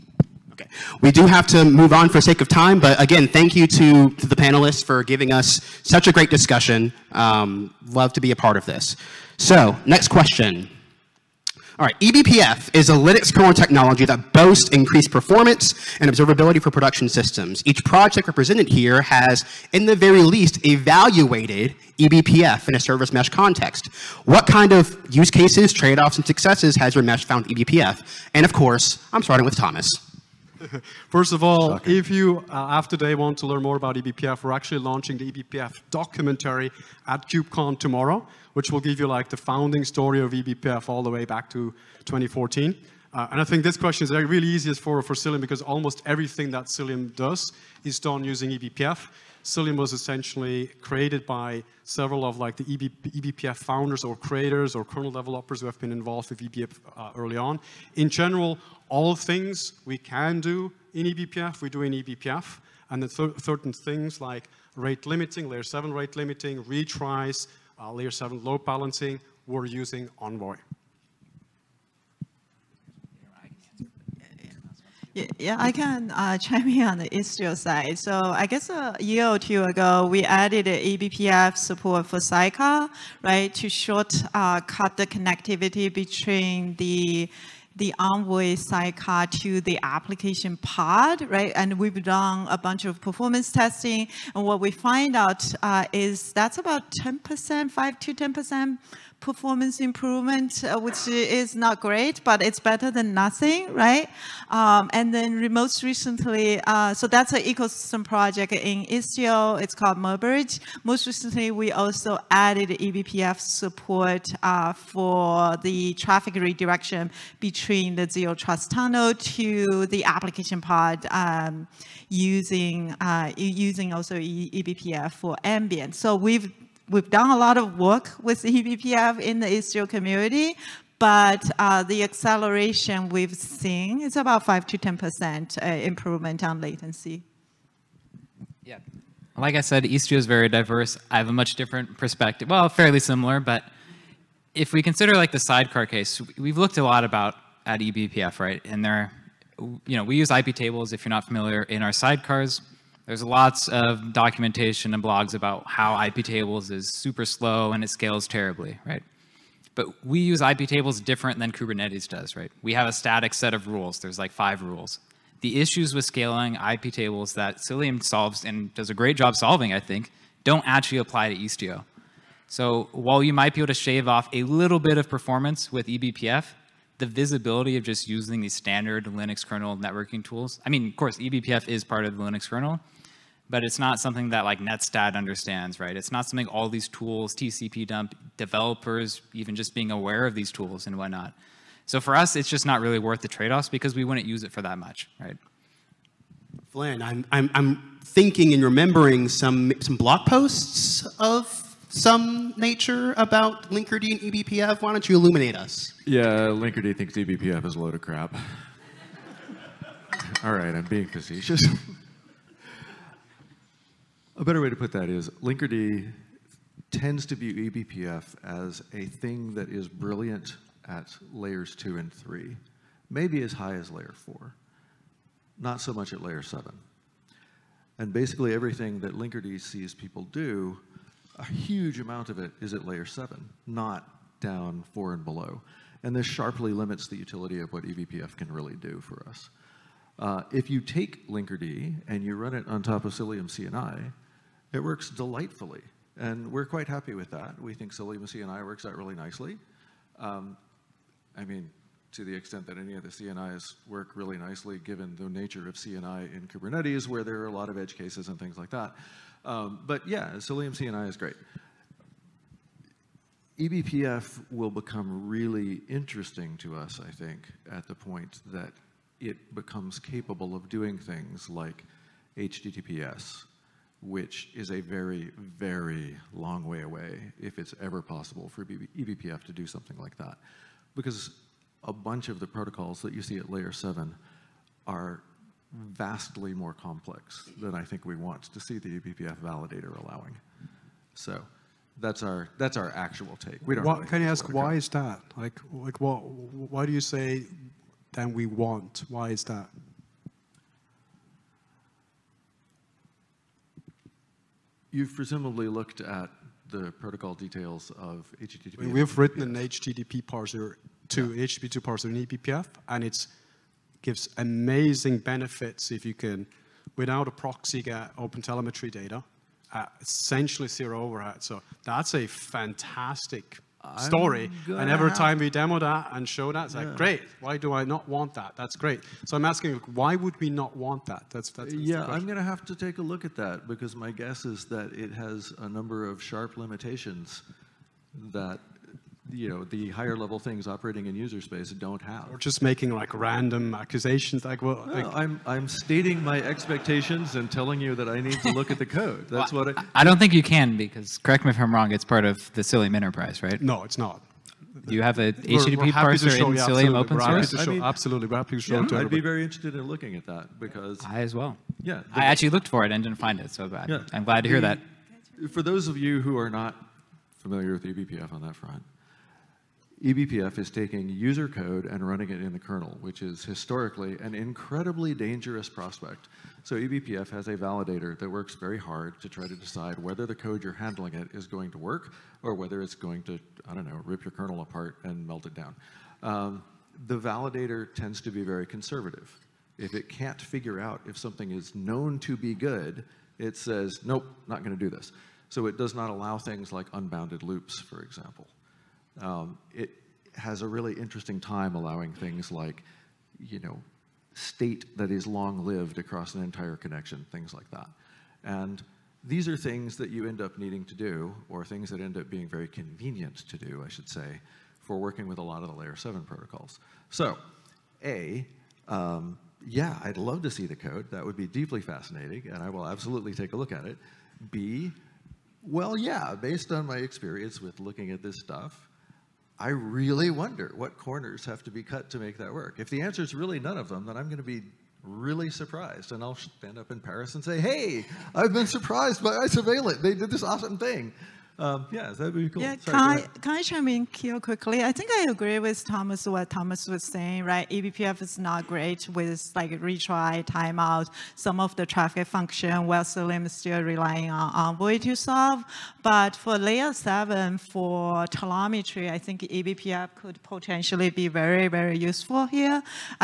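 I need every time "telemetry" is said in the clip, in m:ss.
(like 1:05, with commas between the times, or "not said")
5:18, 7:38.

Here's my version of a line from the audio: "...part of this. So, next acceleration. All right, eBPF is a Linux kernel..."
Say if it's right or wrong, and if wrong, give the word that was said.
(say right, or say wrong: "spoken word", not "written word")
wrong: "question", not "acceleration".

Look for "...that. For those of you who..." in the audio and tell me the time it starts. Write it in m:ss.
6:05.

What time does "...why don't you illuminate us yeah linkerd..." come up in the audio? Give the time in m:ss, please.
3:24.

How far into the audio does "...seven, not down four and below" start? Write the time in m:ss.
3:53.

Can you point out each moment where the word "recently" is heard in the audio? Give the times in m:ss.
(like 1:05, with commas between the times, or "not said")
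1:45, 1:51.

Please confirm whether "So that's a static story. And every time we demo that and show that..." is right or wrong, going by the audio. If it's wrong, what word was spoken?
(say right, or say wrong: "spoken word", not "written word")
wrong: "fantastic", not "static".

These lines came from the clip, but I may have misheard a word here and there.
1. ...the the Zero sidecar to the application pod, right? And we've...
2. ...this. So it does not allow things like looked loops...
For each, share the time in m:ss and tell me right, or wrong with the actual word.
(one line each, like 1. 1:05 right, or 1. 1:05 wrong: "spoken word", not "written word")
1. 1:26 wrong: "Envoy", not "Zero"
2. 6:34 wrong: "unbounded", not "looked".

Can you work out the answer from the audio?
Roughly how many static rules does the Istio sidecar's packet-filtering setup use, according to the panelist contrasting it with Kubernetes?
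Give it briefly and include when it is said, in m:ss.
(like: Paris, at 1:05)
5, at 2:44.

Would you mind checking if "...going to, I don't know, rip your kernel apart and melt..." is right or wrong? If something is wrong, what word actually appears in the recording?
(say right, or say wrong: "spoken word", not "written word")
right.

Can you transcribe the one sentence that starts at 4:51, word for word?
So that's our that's our actual take.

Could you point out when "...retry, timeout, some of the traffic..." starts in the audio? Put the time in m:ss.
7:29.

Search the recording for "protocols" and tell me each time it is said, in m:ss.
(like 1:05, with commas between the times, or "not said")
4:42, 5:06, 6:56.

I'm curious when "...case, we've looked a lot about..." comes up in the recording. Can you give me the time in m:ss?
2:25.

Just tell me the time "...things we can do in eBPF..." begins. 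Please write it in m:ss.
0:59.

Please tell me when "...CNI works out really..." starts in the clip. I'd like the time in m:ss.
4:08.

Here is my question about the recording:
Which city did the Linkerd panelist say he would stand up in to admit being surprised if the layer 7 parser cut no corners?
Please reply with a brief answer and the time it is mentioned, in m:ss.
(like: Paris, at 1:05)
Paris, at 7:17.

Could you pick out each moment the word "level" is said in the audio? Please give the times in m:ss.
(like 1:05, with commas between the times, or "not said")
5:40.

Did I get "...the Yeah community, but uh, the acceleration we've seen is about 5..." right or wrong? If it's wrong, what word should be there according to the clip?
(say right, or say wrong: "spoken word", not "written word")
wrong: "Istio", not "Yeah".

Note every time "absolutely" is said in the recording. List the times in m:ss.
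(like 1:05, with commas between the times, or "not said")
5:57, 7:02.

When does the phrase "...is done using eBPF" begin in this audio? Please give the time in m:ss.
0:47.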